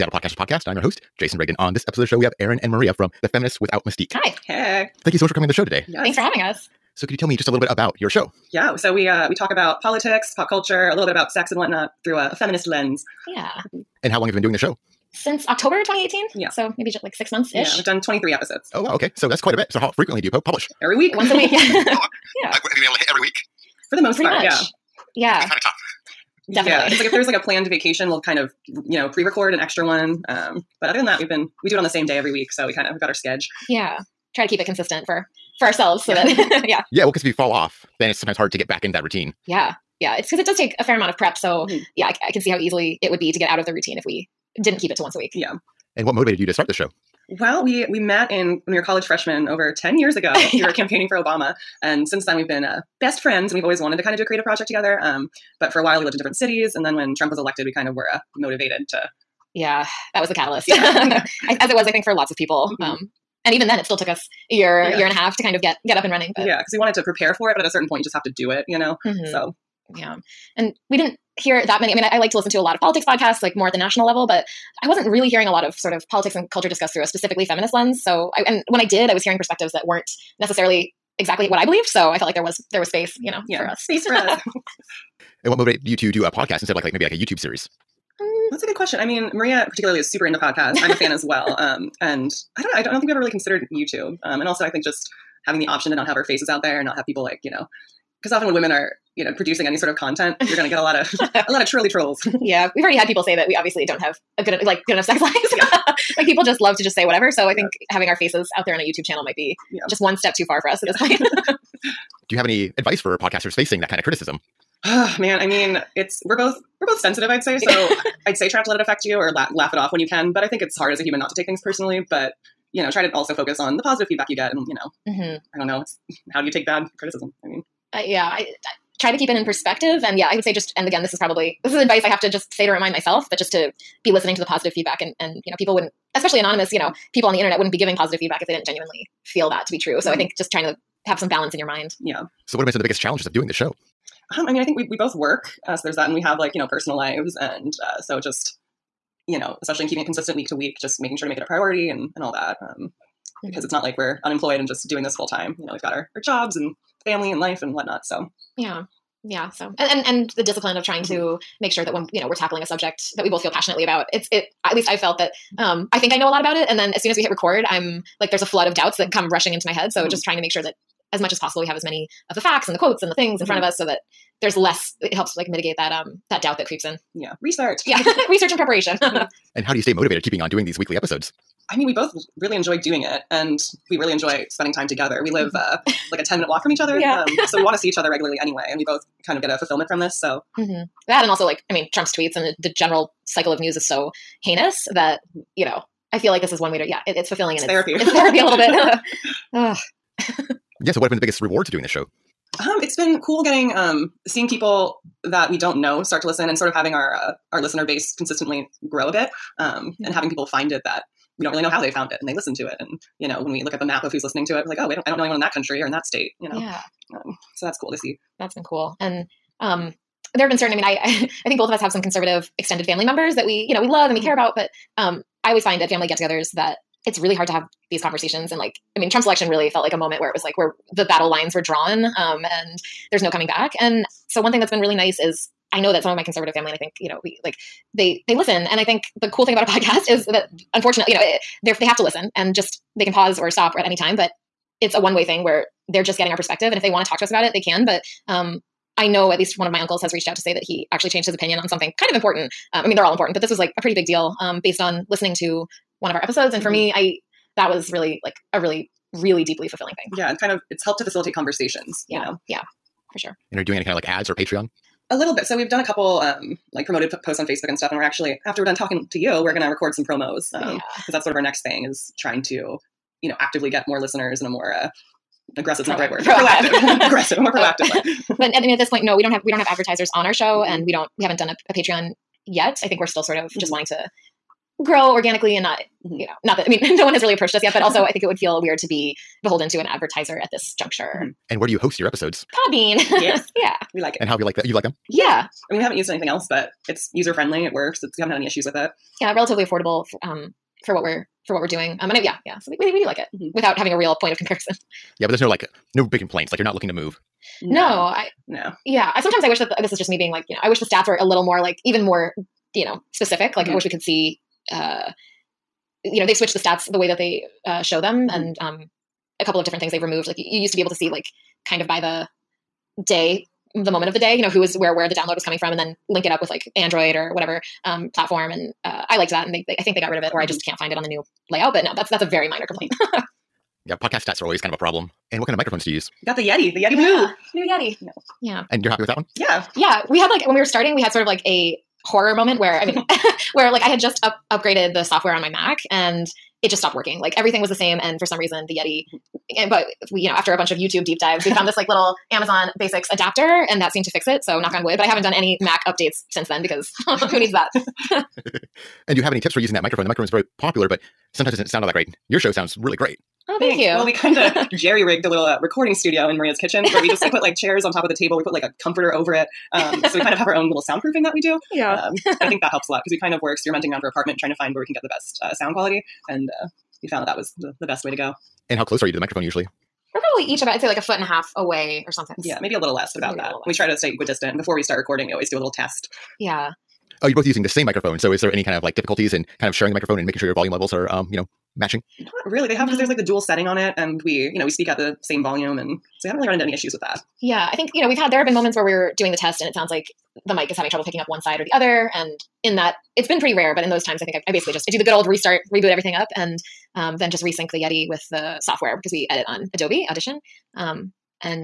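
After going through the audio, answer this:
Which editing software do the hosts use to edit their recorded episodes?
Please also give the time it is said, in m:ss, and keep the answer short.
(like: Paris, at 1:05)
Adobe Audition, at 6:49.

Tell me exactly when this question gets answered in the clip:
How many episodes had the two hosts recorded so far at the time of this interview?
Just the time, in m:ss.
0:18.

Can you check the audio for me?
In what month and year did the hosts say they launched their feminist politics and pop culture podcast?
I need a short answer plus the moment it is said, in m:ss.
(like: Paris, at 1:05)
October 2018, at 0:15.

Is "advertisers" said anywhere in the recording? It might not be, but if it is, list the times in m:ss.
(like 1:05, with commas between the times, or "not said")
4:39, 4:49.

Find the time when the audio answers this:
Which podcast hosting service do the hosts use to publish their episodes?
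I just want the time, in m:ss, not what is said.
4:52.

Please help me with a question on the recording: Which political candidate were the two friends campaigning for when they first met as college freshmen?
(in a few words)
Obama.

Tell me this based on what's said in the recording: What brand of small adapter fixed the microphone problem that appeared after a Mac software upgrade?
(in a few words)
Amazon Basics.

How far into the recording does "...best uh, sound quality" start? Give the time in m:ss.
6:15.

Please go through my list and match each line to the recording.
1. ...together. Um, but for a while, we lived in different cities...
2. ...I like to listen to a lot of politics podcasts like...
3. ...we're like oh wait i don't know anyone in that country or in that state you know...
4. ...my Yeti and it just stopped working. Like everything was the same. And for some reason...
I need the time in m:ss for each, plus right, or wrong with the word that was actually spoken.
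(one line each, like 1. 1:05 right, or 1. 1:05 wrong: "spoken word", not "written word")
1. 0:54 right
2. 1:12 right
3. 3:34 right
4. 5:45 wrong: "Mac", not "Yeti".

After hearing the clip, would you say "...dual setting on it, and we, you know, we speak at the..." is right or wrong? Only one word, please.
right.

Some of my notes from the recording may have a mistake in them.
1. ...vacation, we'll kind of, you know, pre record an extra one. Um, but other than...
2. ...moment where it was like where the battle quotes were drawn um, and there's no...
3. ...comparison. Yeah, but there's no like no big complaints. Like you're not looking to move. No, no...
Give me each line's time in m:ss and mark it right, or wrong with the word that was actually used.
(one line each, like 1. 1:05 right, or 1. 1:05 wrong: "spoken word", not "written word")
1. 0:27 right
2. 3:49 wrong: "lines", not "quotes"
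3. 5:04 right.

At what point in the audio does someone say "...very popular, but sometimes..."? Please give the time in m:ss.
6:00.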